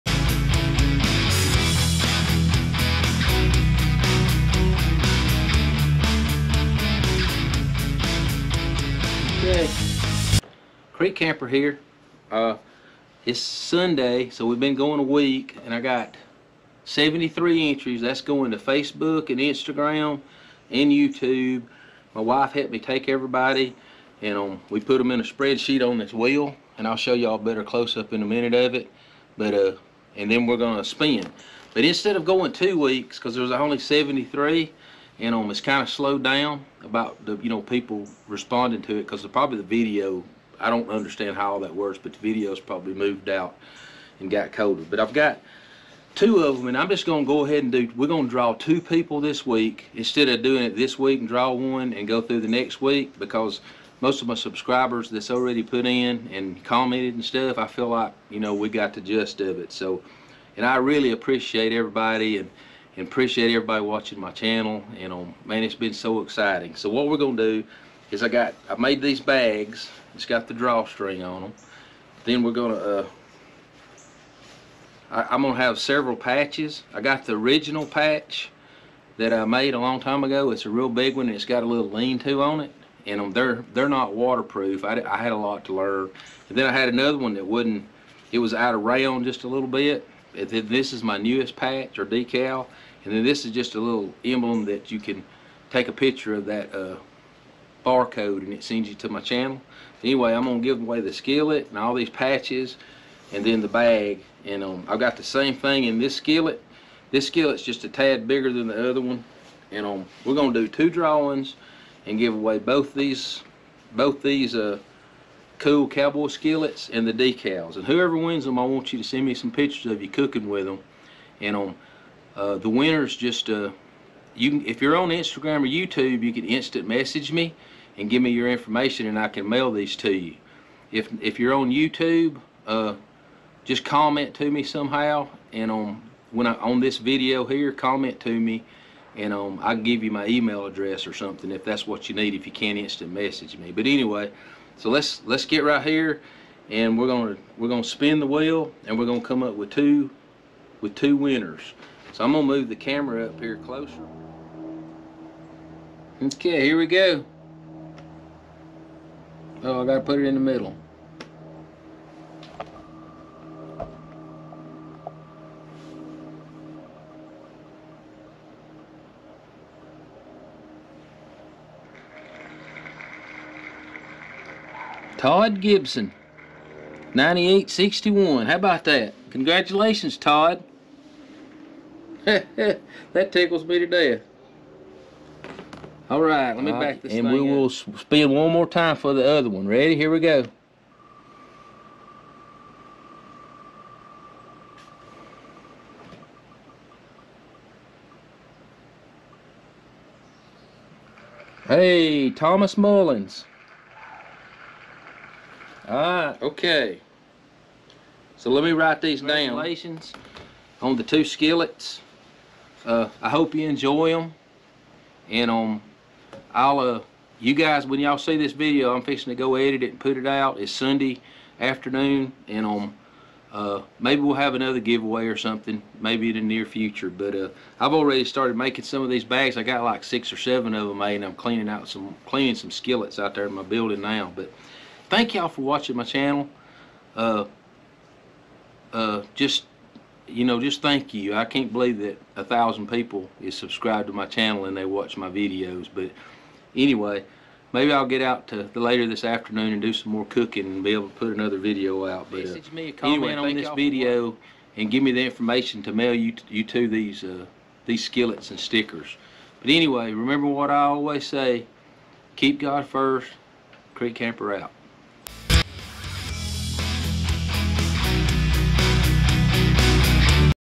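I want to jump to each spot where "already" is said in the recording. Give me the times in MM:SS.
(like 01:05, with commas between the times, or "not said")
00:55, 03:47.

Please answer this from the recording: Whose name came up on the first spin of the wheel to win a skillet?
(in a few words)
Todd Gibson.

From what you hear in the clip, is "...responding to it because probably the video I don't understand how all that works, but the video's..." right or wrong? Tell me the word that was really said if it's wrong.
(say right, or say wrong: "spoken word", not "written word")
right.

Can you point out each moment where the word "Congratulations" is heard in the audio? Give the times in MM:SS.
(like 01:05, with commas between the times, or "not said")
02:59, 03:29.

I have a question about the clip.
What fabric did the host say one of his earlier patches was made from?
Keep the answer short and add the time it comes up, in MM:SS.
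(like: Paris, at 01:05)
rayon, at 01:28.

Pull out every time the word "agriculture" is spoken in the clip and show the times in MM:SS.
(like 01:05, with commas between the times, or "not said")
not said.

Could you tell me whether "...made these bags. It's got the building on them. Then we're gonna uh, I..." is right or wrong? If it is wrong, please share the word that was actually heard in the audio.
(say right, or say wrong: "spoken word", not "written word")
wrong: "drawstring", not "building".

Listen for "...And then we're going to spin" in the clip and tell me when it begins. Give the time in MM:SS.
00:30.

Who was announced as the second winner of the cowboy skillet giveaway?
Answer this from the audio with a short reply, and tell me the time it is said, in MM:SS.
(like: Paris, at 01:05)
Thomas Mullins, at 03:22.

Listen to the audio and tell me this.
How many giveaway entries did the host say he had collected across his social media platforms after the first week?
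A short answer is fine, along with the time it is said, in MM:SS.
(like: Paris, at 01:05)
73, at 00:16.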